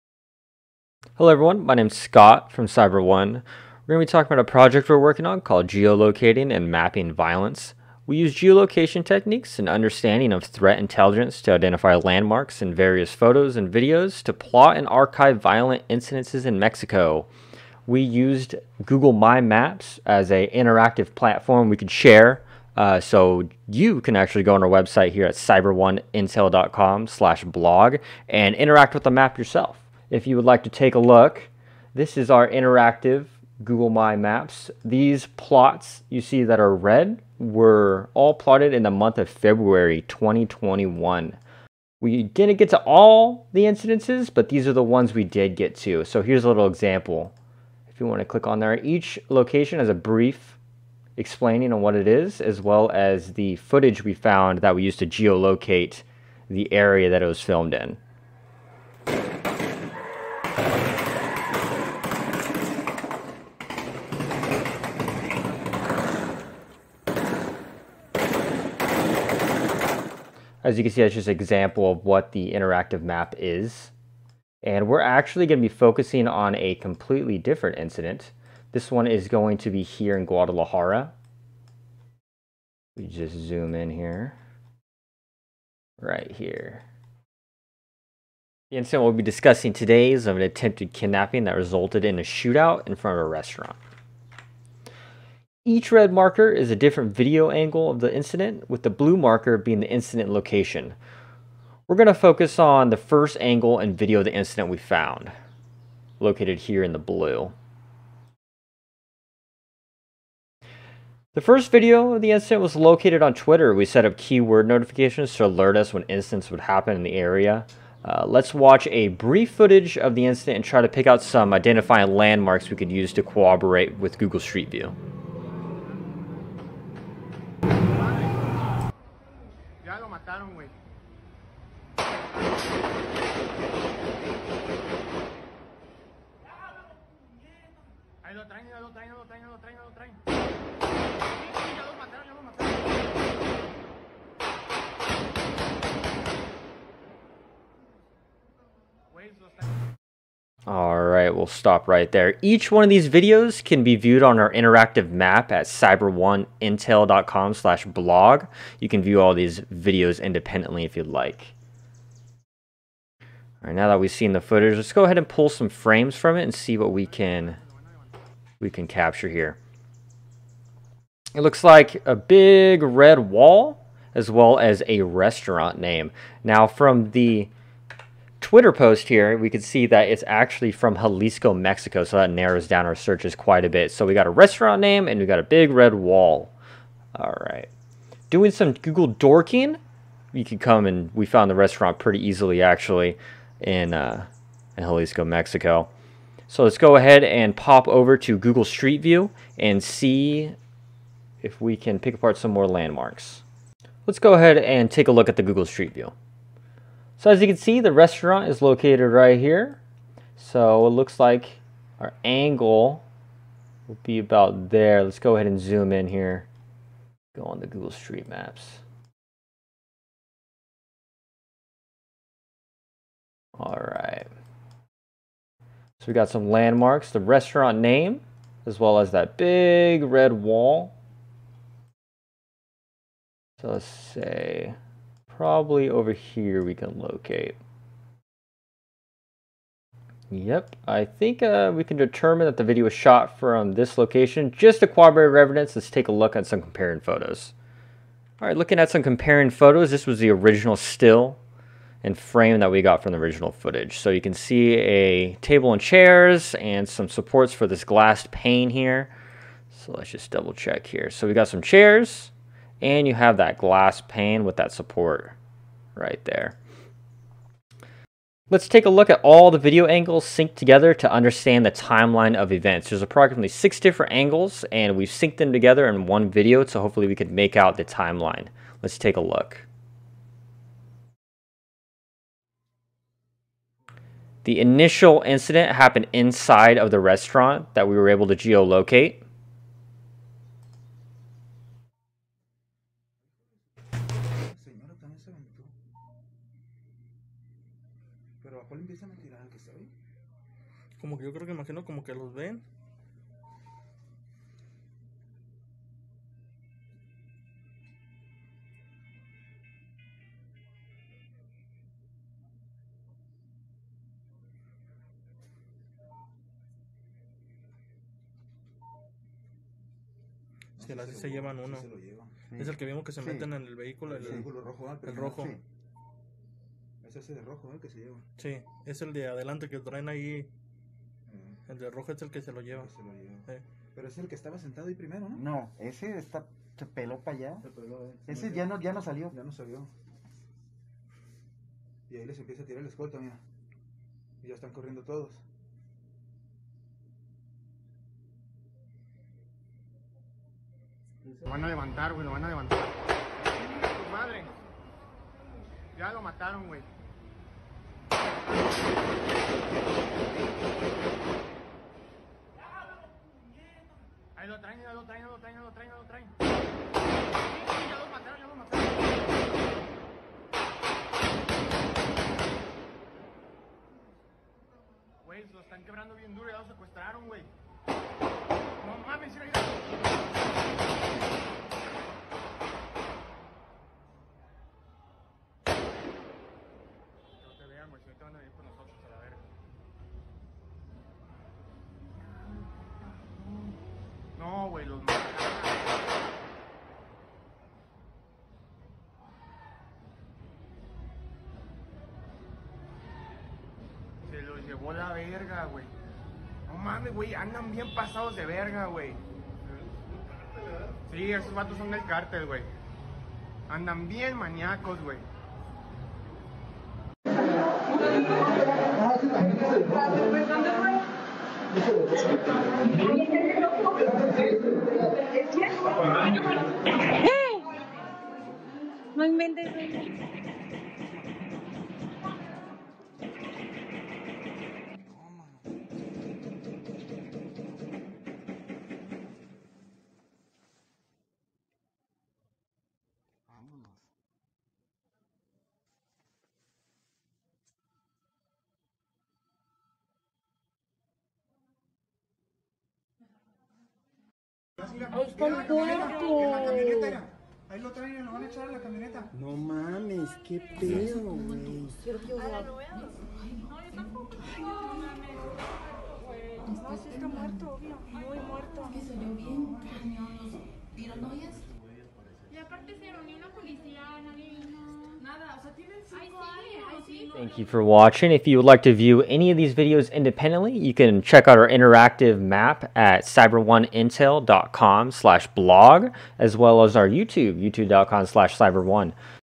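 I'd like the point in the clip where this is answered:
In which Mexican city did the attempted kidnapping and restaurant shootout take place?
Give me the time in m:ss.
1:20.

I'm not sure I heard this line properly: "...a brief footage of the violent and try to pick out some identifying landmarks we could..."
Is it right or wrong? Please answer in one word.
wrong.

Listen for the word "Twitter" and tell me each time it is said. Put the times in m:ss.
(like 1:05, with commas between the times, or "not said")
1:53, 2:58.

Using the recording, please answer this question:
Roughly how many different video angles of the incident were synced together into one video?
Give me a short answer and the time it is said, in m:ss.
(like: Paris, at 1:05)
6, at 4:33.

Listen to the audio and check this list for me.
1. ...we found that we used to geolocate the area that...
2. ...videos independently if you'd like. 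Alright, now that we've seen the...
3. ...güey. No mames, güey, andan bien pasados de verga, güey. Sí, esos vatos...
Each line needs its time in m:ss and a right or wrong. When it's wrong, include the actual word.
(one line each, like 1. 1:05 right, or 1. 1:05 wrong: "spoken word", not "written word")
1. 0:54 right
2. 2:39 right
3. 6:45 right.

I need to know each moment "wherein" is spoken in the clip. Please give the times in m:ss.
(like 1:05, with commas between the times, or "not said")
not said.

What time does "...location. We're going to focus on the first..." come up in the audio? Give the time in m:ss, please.
1:40.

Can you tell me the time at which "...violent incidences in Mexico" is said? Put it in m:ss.
0:15.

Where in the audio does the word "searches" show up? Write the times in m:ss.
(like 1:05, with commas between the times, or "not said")
3:02.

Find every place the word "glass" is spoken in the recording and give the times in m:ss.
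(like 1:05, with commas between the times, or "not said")
4:17, 4:23.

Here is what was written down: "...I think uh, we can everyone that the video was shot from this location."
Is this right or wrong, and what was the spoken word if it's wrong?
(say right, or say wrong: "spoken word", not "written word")
wrong: "determine", not "everyone".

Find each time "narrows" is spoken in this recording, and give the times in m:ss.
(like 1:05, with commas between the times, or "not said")
3:02.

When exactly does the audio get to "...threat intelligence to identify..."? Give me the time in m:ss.
0:10.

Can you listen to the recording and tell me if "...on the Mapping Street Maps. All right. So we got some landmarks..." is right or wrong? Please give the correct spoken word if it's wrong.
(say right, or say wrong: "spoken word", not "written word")
wrong: "Google", not "Mapping".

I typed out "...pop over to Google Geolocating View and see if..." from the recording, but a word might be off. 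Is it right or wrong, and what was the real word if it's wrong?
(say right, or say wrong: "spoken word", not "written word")
wrong: "Street", not "Geolocating".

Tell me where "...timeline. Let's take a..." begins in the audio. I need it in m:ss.
4:37.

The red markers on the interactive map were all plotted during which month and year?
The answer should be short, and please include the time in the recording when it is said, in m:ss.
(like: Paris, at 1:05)
February 2021, at 0:39.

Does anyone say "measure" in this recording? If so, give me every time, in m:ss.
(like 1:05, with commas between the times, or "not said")
not said.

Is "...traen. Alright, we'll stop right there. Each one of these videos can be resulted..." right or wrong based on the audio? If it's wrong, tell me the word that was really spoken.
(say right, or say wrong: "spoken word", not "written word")
wrong: "viewed", not "resulted".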